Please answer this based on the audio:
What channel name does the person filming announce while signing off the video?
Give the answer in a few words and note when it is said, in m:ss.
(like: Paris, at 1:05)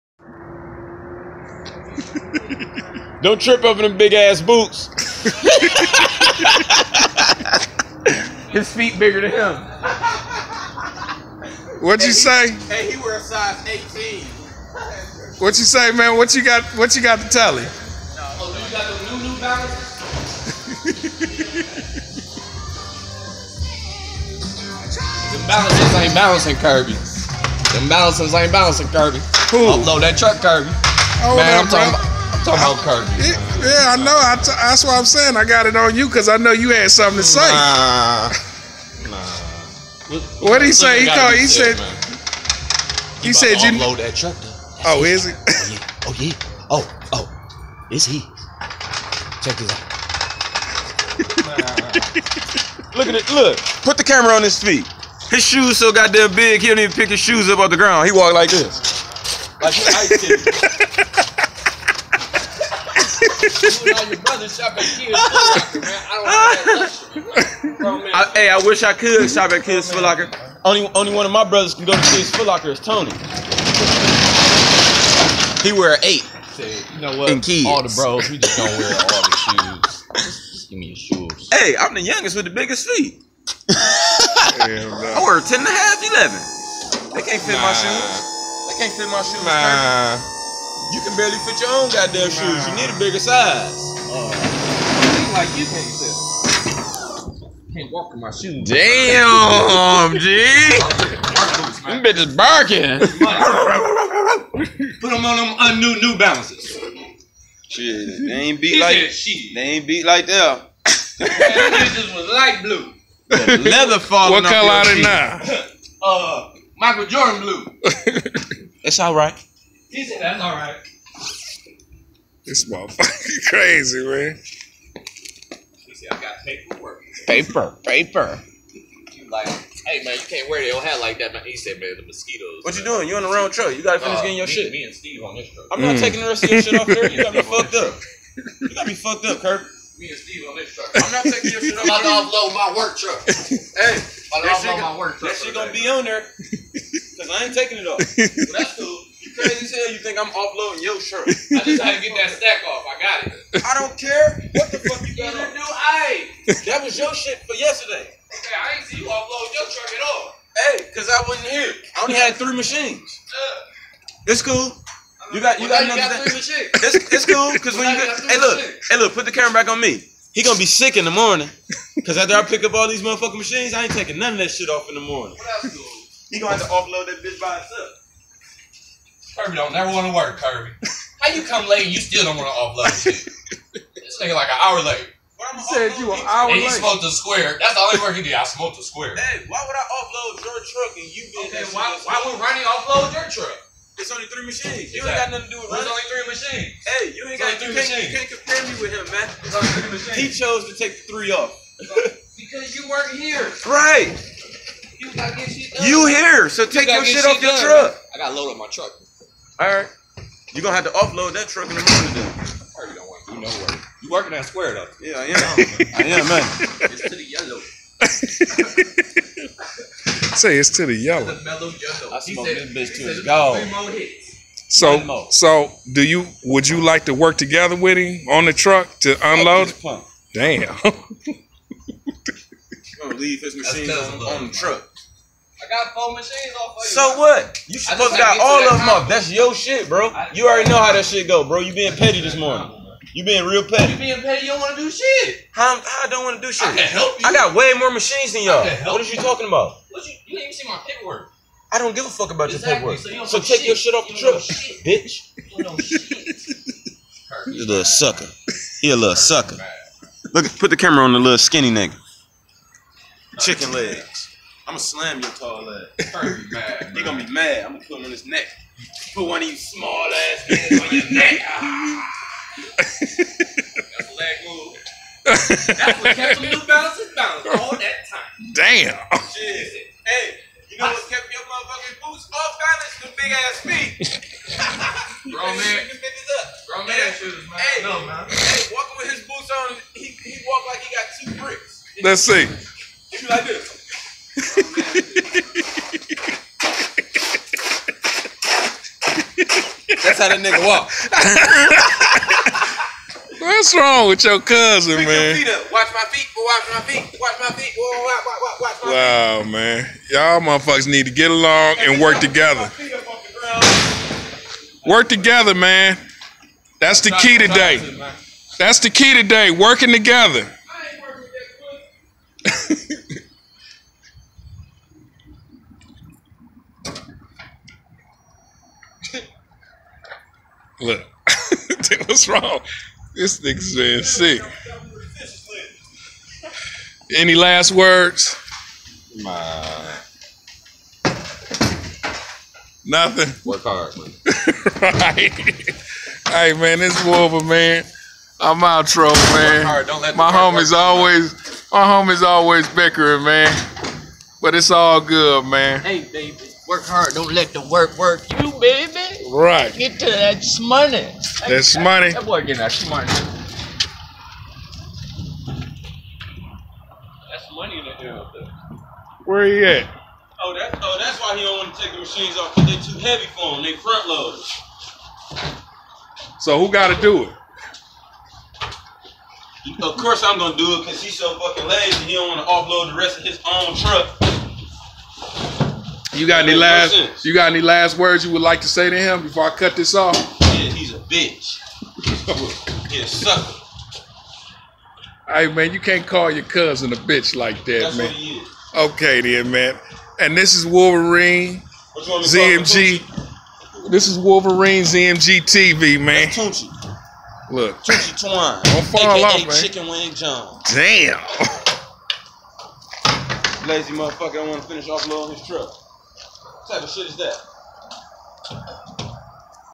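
Wolverine ZMG TV, at 6:44.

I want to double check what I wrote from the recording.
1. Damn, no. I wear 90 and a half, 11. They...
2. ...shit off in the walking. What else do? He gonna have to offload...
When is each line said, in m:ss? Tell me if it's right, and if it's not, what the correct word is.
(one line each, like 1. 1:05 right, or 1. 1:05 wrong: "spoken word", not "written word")
1. 1:24 wrong: "10", not "90"
2. 2:54 wrong: "morning", not "walking".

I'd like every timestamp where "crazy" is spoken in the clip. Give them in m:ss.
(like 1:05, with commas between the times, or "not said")
2:03, 2:29.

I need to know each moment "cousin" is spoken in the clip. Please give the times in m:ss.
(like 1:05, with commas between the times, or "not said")
5:04, 6:36.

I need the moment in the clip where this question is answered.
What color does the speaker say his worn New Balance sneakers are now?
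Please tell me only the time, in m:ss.
1:56.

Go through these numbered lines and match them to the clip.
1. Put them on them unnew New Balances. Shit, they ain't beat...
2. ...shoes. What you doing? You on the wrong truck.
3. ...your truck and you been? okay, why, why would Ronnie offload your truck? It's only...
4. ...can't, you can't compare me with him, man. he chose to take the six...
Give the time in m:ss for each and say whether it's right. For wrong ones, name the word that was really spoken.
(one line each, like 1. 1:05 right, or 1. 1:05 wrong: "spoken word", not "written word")
1. 1:44 right
2. 2:12 wrong: "mosquitoes", not "shoes"
3. 3:10 right
4. 3:17 wrong: "three", not "six".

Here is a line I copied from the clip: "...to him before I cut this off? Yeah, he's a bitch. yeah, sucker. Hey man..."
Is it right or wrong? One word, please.
right.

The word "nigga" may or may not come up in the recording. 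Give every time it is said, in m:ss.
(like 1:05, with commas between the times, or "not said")
3:04, 4:21, 4:30, 5:00, 5:33.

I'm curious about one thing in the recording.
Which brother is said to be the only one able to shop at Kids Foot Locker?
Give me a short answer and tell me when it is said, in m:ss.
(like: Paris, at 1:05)
Tony, at 1:12.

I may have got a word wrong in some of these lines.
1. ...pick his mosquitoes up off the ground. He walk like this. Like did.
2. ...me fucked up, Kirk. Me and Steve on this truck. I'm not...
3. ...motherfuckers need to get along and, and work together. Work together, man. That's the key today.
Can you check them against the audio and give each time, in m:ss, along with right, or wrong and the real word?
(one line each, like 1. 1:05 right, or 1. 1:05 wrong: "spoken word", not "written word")
1. 0:56 wrong: "shoes", not "mosquitoes"
2. 2:18 right
3. 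5:10 right.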